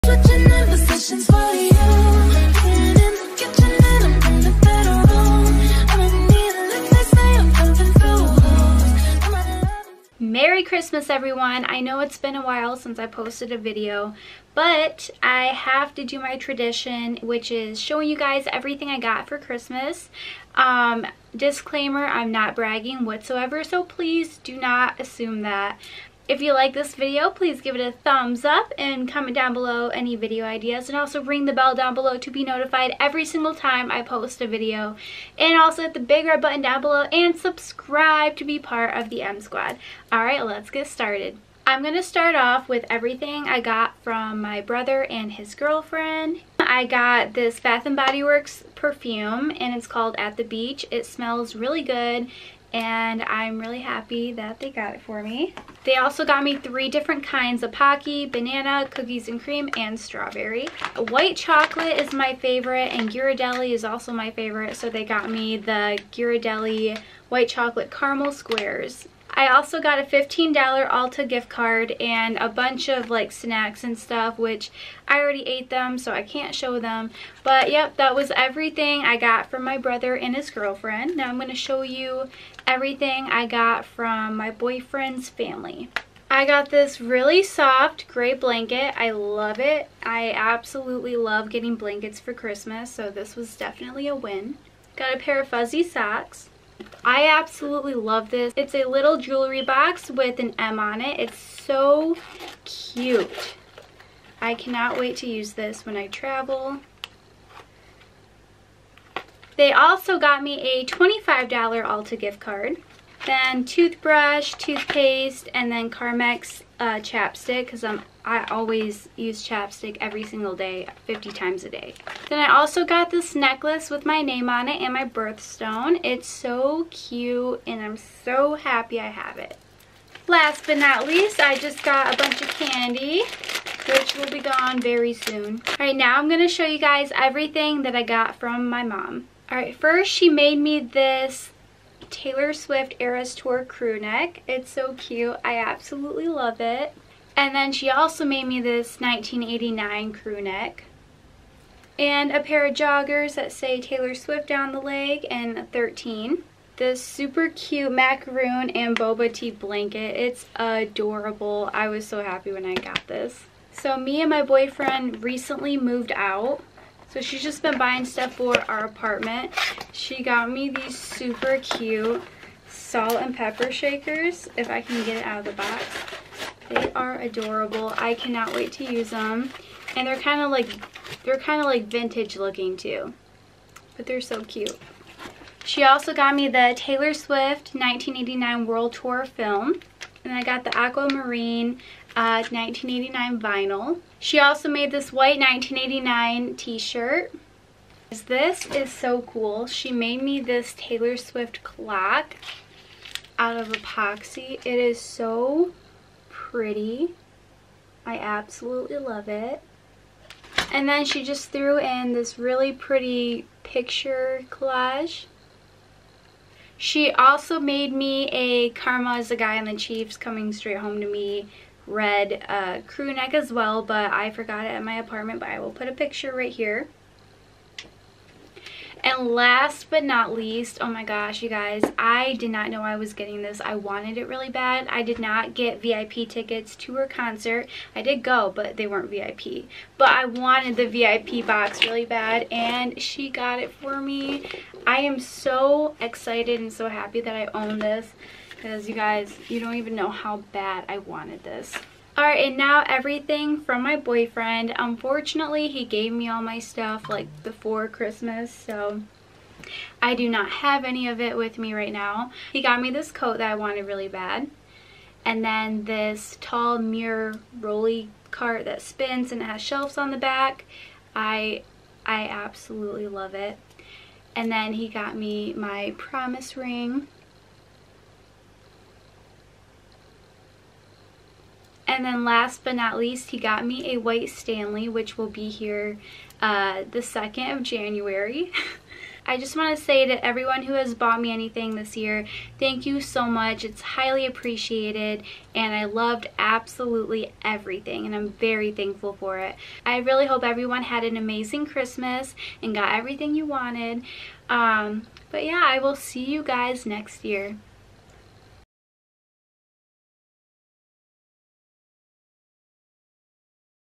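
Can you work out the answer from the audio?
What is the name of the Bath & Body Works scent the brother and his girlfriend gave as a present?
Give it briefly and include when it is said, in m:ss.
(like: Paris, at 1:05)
At The Beach, at 0:50.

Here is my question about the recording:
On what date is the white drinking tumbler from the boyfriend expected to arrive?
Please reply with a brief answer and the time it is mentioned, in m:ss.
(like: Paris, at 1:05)
January 2, at 4:46.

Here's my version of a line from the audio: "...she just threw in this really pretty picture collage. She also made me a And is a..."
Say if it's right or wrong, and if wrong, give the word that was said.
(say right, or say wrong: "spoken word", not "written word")
wrong: "Karma", not "And".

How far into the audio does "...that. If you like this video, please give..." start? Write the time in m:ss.
0:25.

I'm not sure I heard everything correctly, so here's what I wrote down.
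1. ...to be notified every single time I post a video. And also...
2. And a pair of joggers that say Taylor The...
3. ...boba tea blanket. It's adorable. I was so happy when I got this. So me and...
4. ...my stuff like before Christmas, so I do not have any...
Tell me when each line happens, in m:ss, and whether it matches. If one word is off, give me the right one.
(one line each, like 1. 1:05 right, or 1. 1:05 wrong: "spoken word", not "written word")
1. 0:32 right
2. 2:31 wrong: "Swift", not "The"
3. 2:38 right
4. 4:16 right.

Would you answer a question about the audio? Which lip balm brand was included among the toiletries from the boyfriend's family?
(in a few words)
Carmex.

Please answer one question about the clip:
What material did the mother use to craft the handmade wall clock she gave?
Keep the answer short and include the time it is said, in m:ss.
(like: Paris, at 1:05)
Epoxy, at 3:23.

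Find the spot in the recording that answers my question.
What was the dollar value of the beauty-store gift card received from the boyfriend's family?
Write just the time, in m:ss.
1:50.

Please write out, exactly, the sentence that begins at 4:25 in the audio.
And then this tall mirror rolly cart that spins and has shelves on the back.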